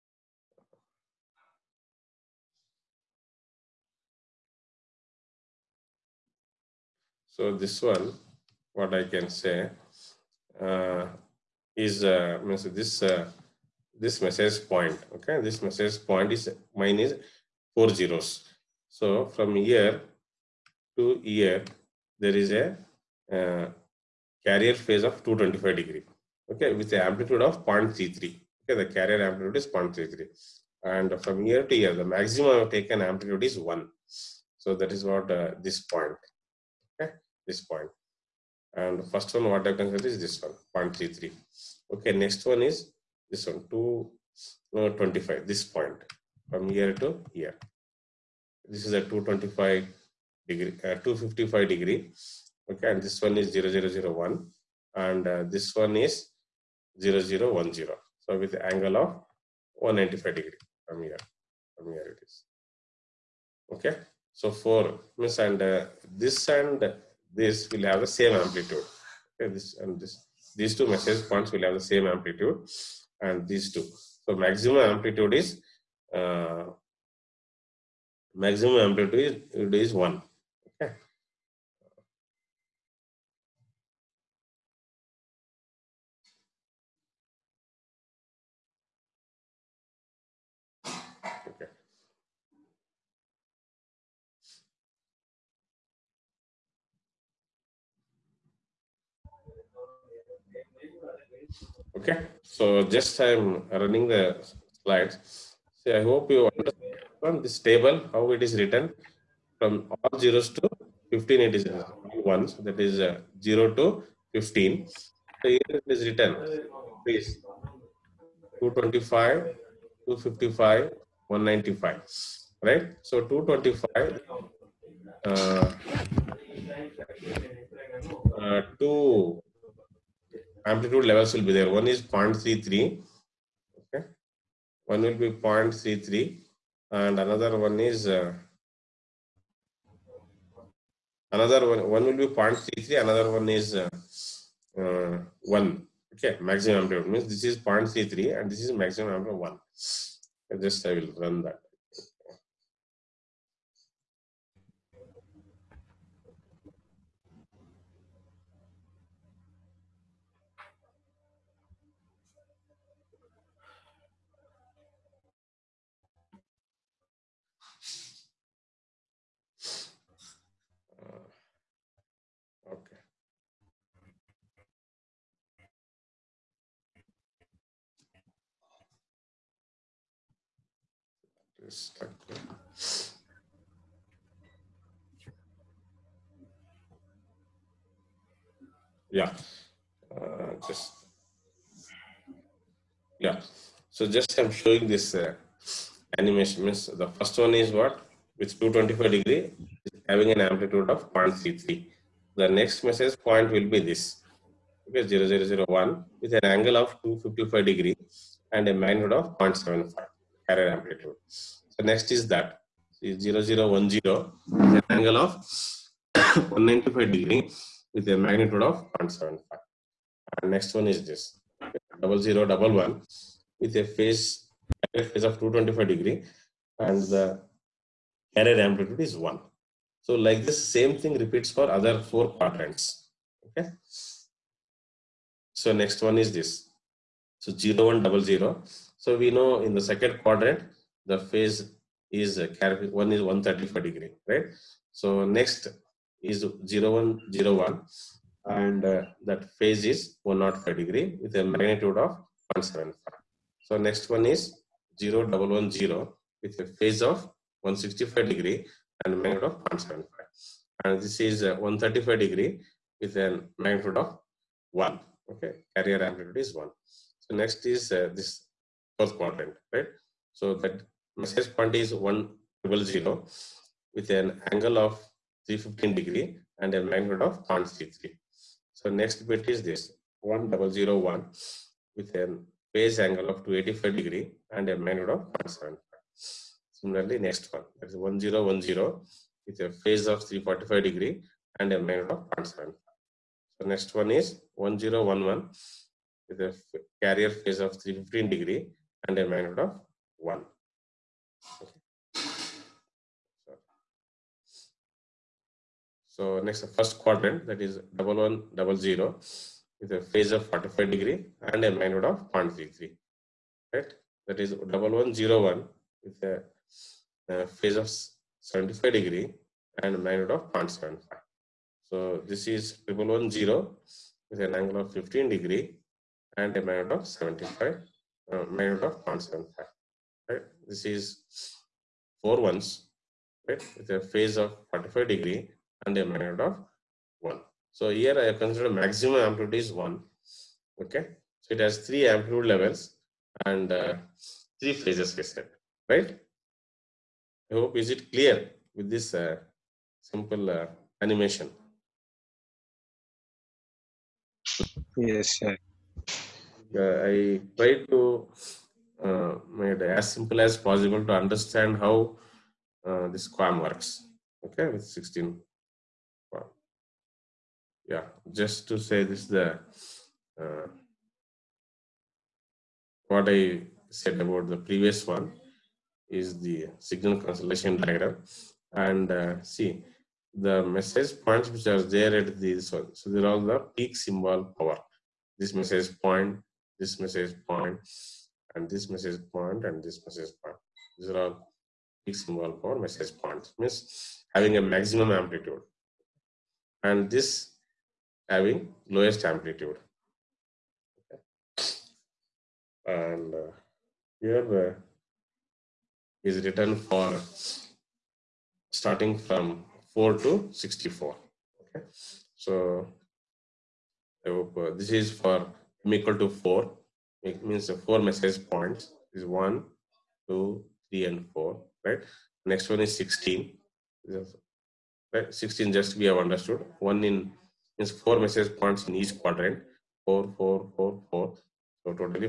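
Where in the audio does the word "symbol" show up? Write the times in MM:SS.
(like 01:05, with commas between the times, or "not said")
06:24, 06:32.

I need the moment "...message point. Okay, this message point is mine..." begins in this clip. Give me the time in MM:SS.
00:14.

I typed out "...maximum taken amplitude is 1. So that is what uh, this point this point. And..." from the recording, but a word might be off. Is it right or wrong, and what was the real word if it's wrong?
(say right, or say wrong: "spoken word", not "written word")
right.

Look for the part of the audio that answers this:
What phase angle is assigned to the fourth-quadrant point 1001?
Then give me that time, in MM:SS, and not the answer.
04:43.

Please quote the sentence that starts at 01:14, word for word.
So maximum amplitude is uh, maximum amplitude is, is one.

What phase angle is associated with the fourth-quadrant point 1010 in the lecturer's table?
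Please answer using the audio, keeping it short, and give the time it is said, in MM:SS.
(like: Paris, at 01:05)
345 degrees, at 04:50.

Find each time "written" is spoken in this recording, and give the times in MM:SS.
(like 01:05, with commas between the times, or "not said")
01:48, 01:56, 06:46.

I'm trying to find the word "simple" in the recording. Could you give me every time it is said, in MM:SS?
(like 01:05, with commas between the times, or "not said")
05:50, 06:00.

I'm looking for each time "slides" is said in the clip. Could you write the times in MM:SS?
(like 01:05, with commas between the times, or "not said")
01:44.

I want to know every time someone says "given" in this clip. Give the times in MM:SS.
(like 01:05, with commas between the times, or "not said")
not said.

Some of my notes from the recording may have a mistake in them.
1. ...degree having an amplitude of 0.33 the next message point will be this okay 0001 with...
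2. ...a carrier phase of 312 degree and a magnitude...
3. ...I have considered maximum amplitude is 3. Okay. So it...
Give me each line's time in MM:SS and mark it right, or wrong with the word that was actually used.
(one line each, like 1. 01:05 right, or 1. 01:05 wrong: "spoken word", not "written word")
1. 03:19 right
2. 04:56 wrong: "315", not "312"
3. 05:38 wrong: "1", not "3".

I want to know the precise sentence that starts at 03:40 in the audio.
And next one is this, double zero double one with a phase, phase of 225 degree and the error amplitude is 1.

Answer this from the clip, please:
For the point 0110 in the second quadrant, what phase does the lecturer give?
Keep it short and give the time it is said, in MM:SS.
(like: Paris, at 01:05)
165 degrees, at 04:17.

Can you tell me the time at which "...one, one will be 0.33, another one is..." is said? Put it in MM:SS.
02:21.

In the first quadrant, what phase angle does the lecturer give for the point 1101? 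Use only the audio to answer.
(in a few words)
75 degrees.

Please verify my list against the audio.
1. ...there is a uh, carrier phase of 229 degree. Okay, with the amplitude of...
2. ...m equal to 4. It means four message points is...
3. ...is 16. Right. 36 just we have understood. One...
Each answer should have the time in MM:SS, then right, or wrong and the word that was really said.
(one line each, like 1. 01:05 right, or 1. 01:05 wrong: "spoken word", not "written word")
1. 00:22 wrong: "225", not "229"
2. 06:55 right
3. 07:02 wrong: "16", not "36".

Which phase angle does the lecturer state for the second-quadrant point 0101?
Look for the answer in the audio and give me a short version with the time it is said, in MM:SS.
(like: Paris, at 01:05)
105 degrees, at 04:10.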